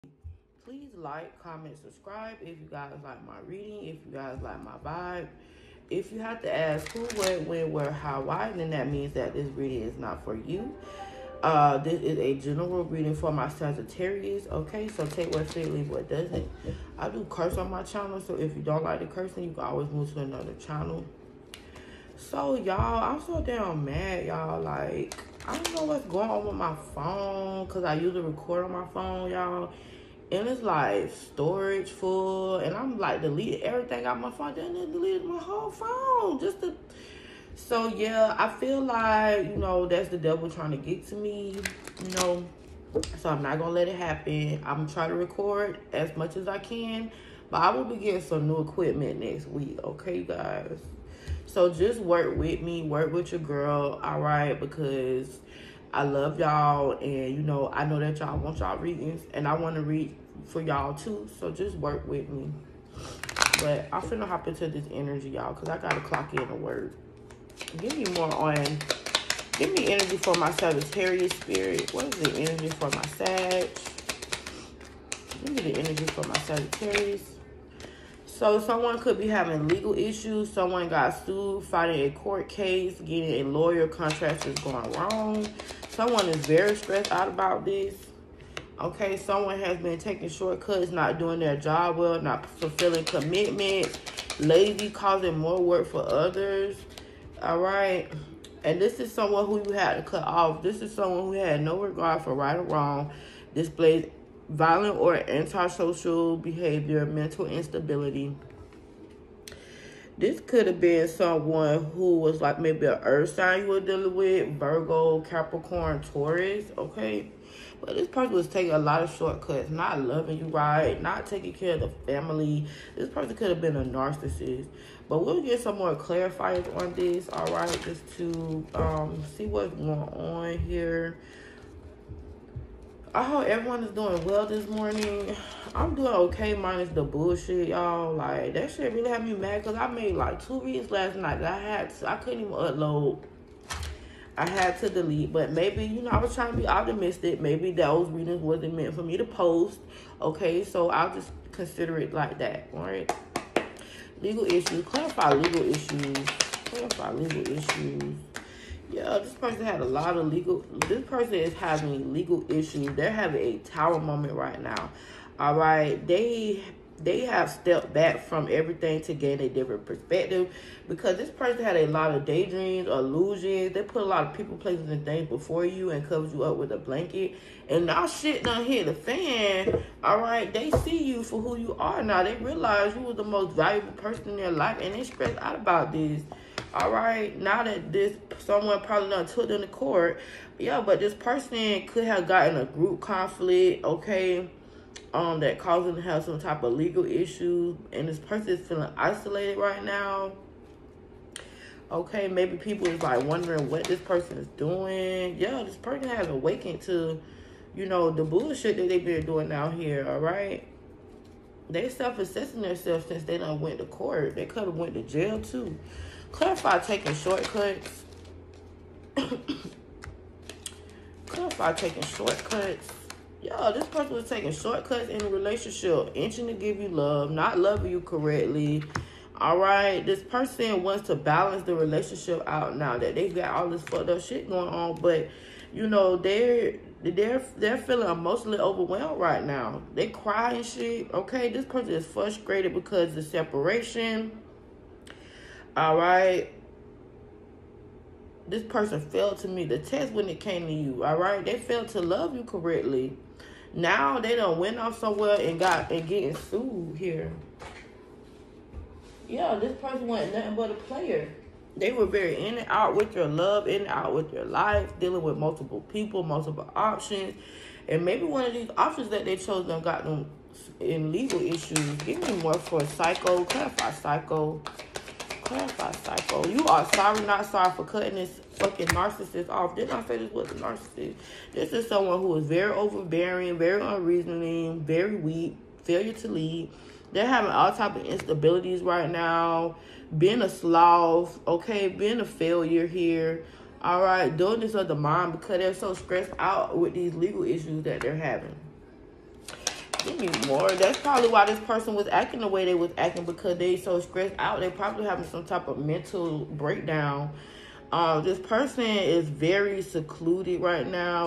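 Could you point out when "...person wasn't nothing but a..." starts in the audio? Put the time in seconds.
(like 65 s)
259 s.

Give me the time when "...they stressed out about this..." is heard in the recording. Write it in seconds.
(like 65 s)
184 s.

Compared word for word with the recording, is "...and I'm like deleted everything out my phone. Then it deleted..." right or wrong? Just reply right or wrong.
right.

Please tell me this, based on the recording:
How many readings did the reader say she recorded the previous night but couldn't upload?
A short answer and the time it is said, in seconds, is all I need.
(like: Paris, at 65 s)
2, at 140 s.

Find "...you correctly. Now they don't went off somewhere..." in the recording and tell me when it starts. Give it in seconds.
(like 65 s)
252 s.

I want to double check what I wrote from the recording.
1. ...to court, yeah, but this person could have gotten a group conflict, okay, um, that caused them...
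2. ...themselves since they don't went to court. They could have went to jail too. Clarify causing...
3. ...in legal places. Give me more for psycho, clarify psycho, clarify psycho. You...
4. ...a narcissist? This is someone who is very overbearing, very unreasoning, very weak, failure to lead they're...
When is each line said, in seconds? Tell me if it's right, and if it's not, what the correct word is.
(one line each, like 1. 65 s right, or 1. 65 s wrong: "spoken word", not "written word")
1. 189 s right
2. 212 s wrong: "taking", not "causing"
3. 270 s wrong: "issues", not "places"
4. 280 s right.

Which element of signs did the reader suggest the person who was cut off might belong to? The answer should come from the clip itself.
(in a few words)
Earth sign.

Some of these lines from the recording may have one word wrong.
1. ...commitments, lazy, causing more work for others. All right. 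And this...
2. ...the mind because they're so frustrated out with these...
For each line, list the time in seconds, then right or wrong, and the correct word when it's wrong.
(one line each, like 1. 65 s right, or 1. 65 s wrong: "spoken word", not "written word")
1. 93 s right
2. 294 s wrong: "stressed", not "frustrated".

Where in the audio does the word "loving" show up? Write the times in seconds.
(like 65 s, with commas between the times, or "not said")
120 s, 227 s.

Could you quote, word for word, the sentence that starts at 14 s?
So take what fit, leave what doesn't.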